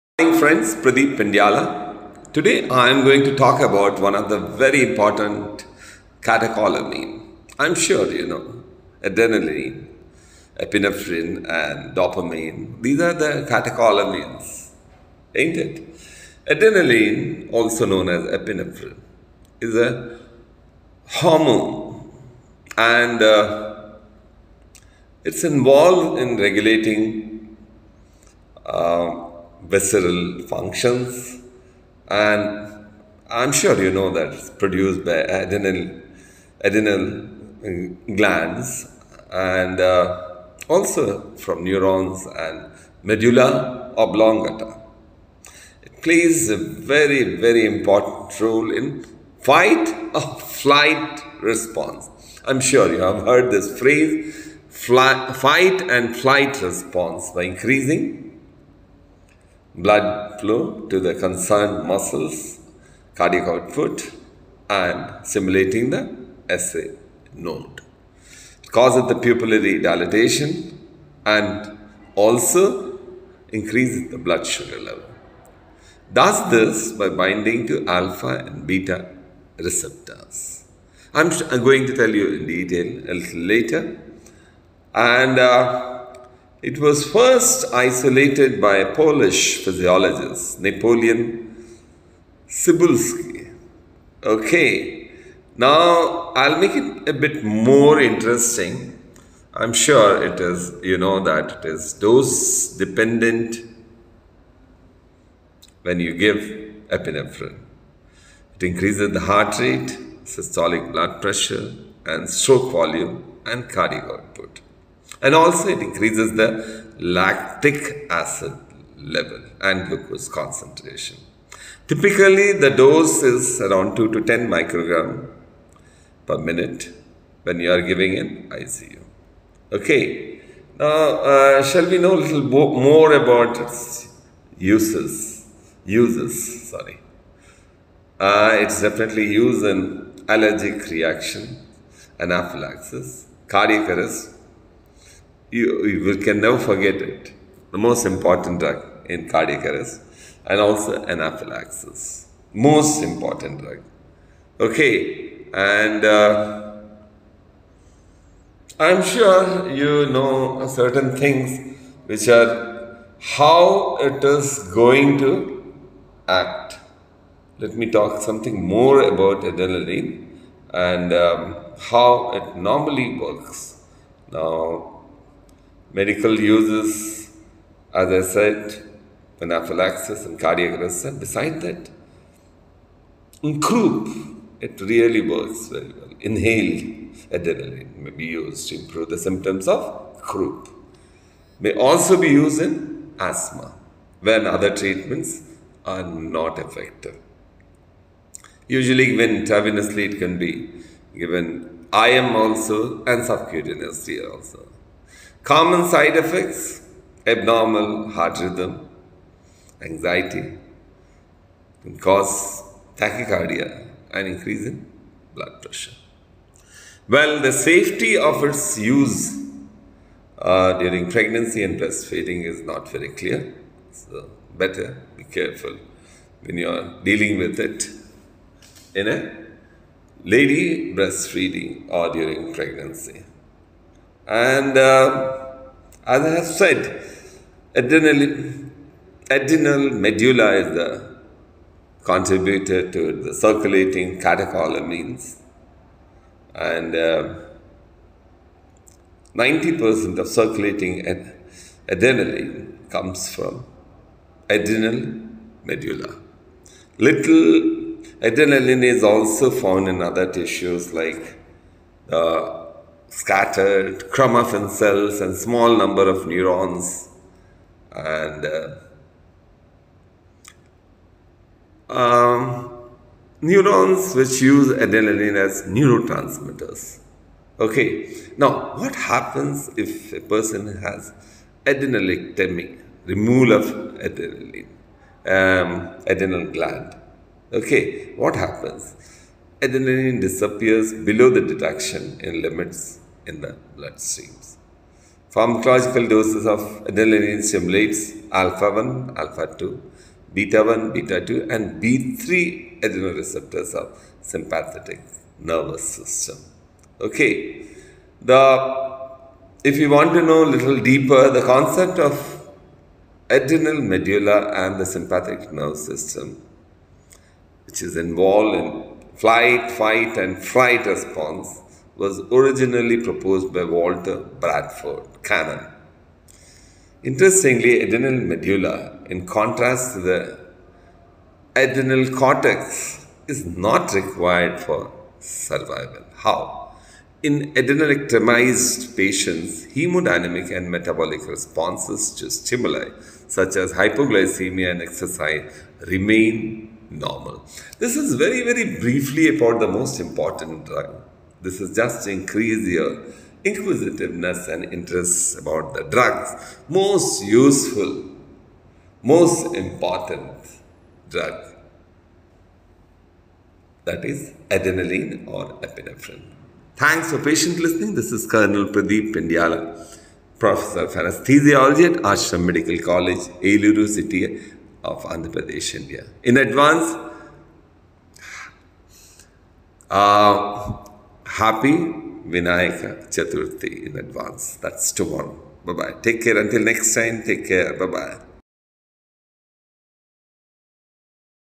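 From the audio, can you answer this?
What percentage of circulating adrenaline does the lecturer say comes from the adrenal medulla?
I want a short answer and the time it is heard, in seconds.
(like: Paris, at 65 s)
90%, at 249 s.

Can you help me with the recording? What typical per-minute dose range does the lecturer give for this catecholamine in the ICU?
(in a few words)
2 to 10 micrograms per minute.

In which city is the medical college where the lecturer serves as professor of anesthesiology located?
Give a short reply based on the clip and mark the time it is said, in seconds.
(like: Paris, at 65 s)
Eluru, at 373 s.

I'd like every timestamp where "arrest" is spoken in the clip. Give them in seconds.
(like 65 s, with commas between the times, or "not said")
143 s, 149 s, 180 s.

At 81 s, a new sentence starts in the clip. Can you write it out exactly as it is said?
I'm, I'm going to tell you in detail a little later.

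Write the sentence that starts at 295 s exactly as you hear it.
Pharmacological doses of adrenaline stimulates alpha 1, alpha 2, beta 1, beta 2, and B3 receptors of sympathetic nervous system.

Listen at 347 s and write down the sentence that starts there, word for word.
This is very, very briefly about the most important drug this is just increase your inquisitiveness and interest about the drugs.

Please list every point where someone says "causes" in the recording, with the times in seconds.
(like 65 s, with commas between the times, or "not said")
68 s, 211 s.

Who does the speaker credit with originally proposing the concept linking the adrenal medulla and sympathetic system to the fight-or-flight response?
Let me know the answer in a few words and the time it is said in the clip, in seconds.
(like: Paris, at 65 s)
Walter Bradford Cannon, at 323 s.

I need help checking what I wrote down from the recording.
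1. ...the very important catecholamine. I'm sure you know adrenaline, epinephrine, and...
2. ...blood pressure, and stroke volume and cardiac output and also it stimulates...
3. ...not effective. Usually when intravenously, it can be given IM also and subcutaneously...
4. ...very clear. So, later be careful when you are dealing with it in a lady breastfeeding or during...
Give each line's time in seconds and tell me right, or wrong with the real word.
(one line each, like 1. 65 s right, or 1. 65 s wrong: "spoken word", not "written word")
1. 4 s right
2. 110 s wrong: "increases", not "stimulates"
3. 196 s right
4. 222 s wrong: "better", not "later".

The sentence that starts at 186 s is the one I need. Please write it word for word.
Inhaled, adrenaline may be used to improve the symptoms of croup.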